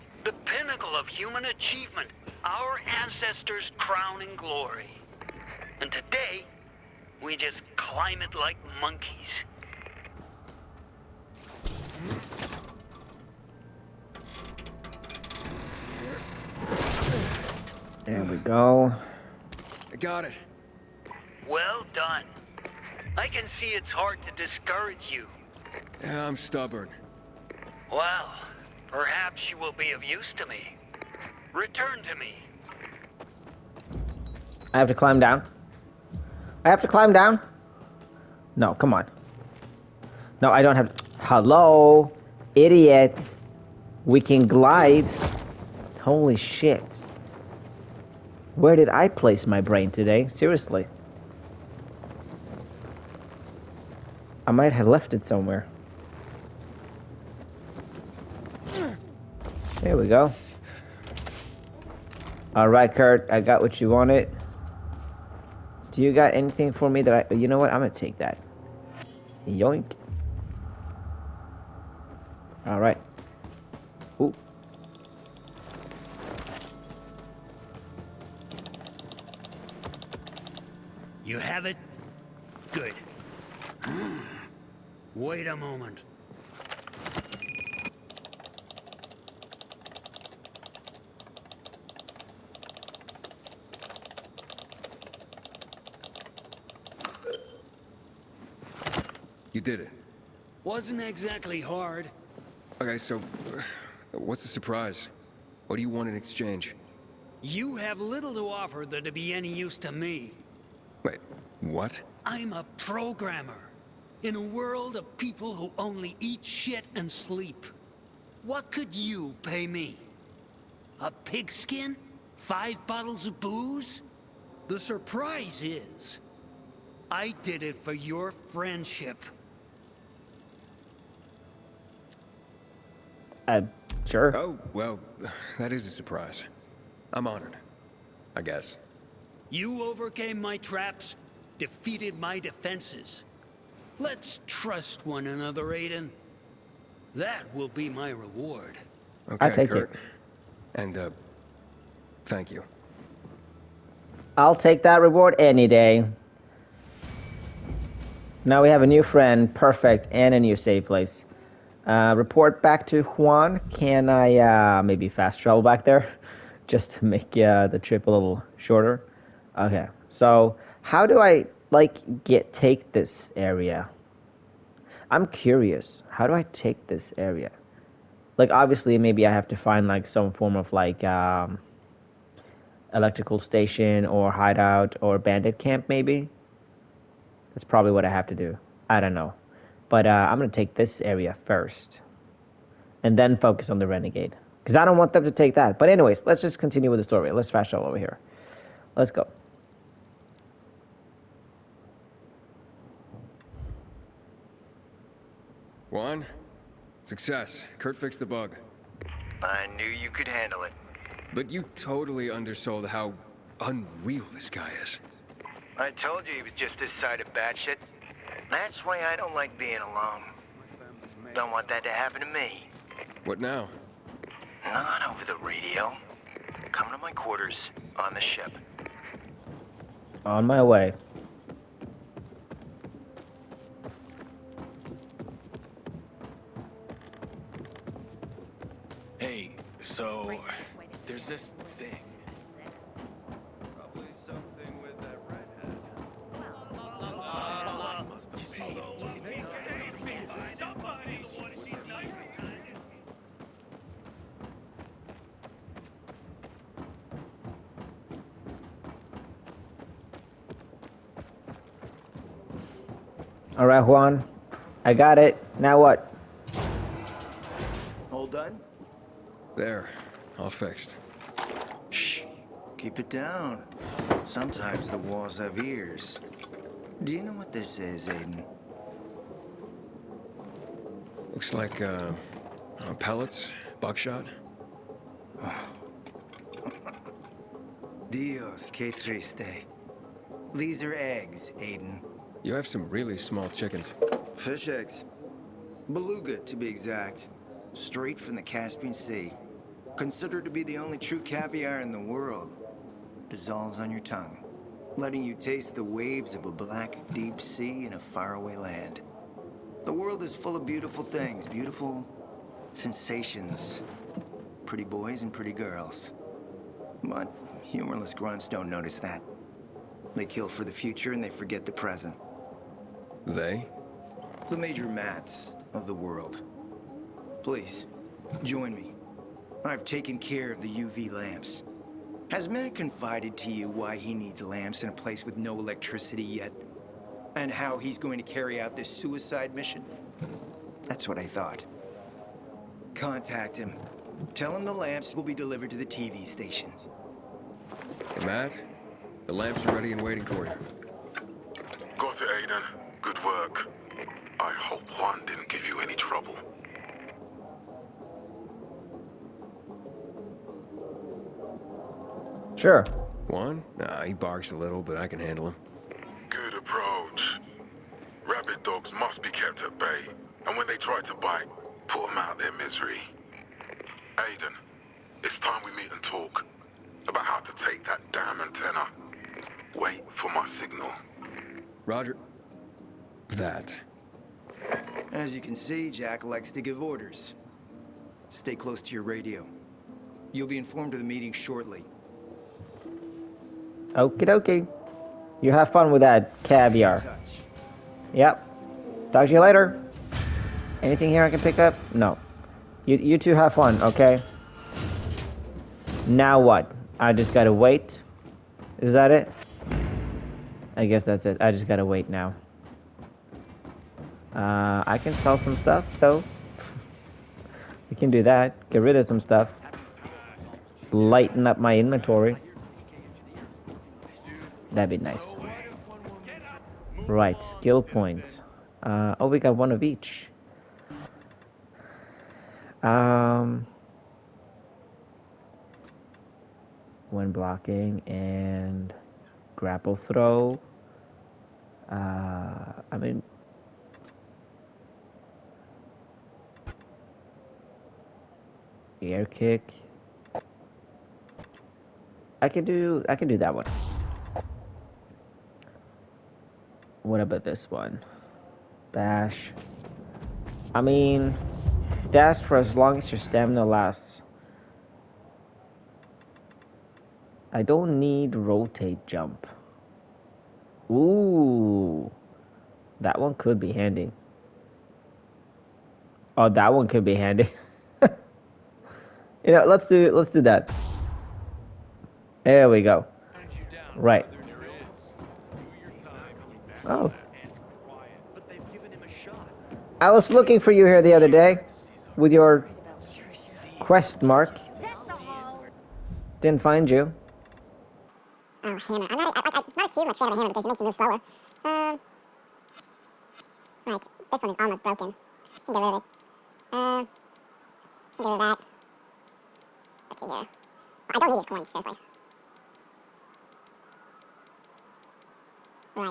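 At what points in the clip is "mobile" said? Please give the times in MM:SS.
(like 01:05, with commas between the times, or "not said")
not said.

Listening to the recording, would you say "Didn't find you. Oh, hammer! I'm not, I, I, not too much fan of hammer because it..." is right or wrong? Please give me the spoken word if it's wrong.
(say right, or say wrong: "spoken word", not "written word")
right.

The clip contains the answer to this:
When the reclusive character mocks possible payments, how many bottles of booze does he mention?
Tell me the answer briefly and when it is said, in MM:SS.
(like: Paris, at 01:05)
5, at 02:02.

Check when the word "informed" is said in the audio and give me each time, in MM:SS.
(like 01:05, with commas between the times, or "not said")
06:30.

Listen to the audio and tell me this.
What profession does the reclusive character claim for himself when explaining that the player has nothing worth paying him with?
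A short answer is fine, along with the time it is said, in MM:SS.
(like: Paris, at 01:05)
Programmer, at 01:52.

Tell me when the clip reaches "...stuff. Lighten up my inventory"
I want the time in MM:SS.
06:59.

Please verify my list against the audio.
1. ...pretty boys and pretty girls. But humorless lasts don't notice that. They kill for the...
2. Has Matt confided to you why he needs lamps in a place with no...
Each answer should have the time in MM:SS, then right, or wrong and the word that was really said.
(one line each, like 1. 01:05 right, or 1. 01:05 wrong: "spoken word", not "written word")
1. 05:14 wrong: "grunts", not "lasts"
2. 05:32 right.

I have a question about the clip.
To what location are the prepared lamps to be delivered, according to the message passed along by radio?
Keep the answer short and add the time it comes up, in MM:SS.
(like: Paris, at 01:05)
TV station, at 05:45.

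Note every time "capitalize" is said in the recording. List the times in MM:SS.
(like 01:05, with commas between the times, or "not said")
not said.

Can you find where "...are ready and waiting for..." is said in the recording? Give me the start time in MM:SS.
05:49.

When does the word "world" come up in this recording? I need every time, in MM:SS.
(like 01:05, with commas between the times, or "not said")
01:54, 05:01, 05:09, 05:25.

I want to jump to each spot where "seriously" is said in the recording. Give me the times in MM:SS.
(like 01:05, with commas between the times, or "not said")
00:50, 08:31.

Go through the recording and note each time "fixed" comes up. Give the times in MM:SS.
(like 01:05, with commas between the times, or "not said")
03:27, 04:30.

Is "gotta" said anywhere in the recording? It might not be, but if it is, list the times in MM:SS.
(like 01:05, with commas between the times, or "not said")
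06:47, 06:51.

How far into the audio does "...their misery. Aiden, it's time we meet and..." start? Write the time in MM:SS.
06:12.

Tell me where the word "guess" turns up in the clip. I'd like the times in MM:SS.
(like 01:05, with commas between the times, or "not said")
02:18, 06:50.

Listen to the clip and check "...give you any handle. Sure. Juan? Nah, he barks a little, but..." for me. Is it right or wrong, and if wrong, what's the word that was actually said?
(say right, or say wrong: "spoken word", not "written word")
wrong: "trouble", not "handle".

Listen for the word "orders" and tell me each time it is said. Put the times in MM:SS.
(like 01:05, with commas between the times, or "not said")
06:26.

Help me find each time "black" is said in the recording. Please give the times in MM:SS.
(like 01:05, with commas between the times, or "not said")
05:06.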